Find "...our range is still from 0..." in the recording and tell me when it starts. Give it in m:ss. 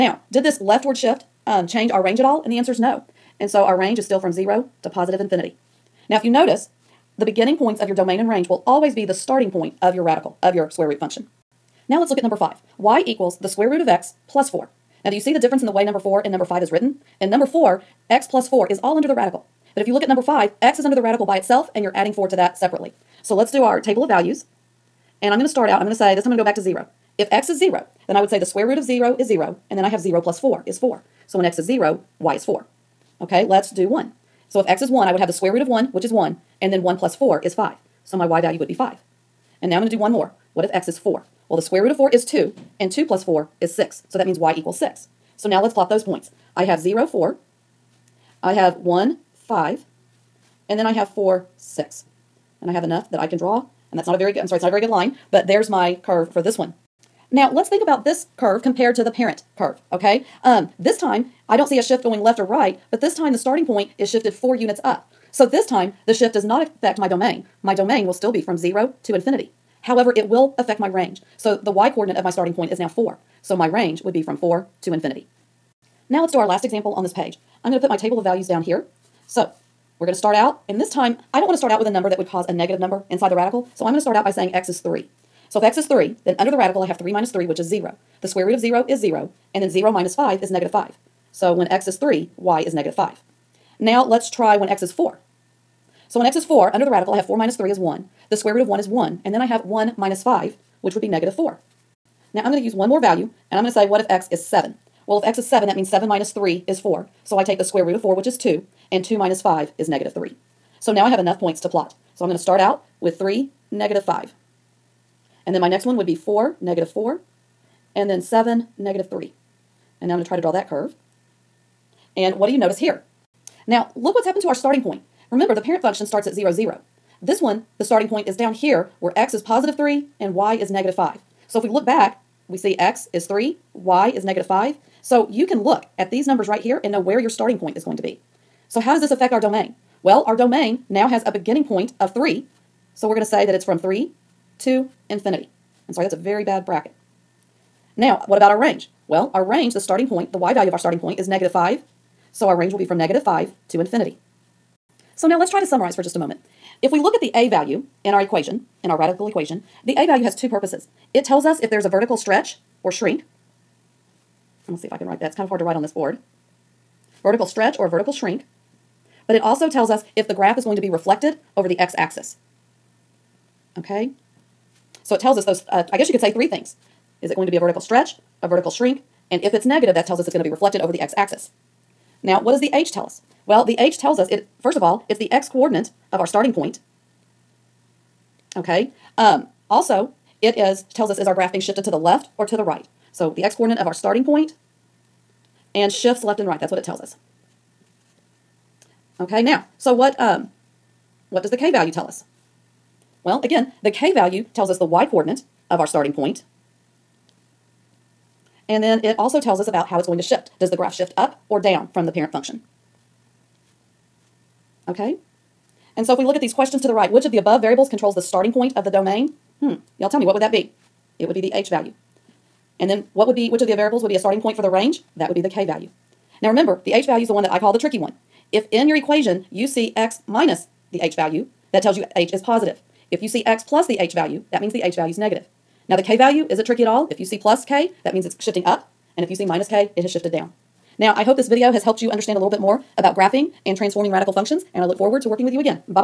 0:03.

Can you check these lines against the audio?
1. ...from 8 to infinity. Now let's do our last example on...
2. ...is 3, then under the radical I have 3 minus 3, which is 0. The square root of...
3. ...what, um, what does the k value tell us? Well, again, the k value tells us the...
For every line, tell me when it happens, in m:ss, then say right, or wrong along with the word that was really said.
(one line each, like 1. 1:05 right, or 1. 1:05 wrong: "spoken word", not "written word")
1. 1:14 wrong: "4", not "8"
2. 1:25 right
3. 3:19 right.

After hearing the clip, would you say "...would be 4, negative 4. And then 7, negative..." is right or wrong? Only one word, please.
right.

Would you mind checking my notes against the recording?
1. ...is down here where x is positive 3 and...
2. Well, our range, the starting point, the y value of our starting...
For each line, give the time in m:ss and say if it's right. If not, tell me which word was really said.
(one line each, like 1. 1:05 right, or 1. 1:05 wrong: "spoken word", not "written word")
1. 2:08 right
2. 2:29 right.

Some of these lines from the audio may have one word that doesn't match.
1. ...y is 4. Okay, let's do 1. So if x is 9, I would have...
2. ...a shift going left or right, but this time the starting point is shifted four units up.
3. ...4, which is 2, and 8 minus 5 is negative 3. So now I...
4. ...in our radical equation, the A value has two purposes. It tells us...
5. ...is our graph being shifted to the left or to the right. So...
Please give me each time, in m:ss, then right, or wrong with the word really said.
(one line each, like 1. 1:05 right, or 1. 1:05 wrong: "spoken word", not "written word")
1. 0:32 wrong: "1", not "9"
2. 1:01 right
3. 1:48 wrong: "2", not "8"
4. 2:38 right
5. 3:11 right.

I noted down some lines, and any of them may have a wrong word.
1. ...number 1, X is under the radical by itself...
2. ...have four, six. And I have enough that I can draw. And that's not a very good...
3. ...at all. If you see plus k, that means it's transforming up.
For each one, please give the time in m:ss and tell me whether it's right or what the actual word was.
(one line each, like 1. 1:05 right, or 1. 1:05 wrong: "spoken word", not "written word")
1. 0:20 wrong: "5", not "1"
2. 0:50 right
3. 3:56 wrong: "shifting", not "transforming".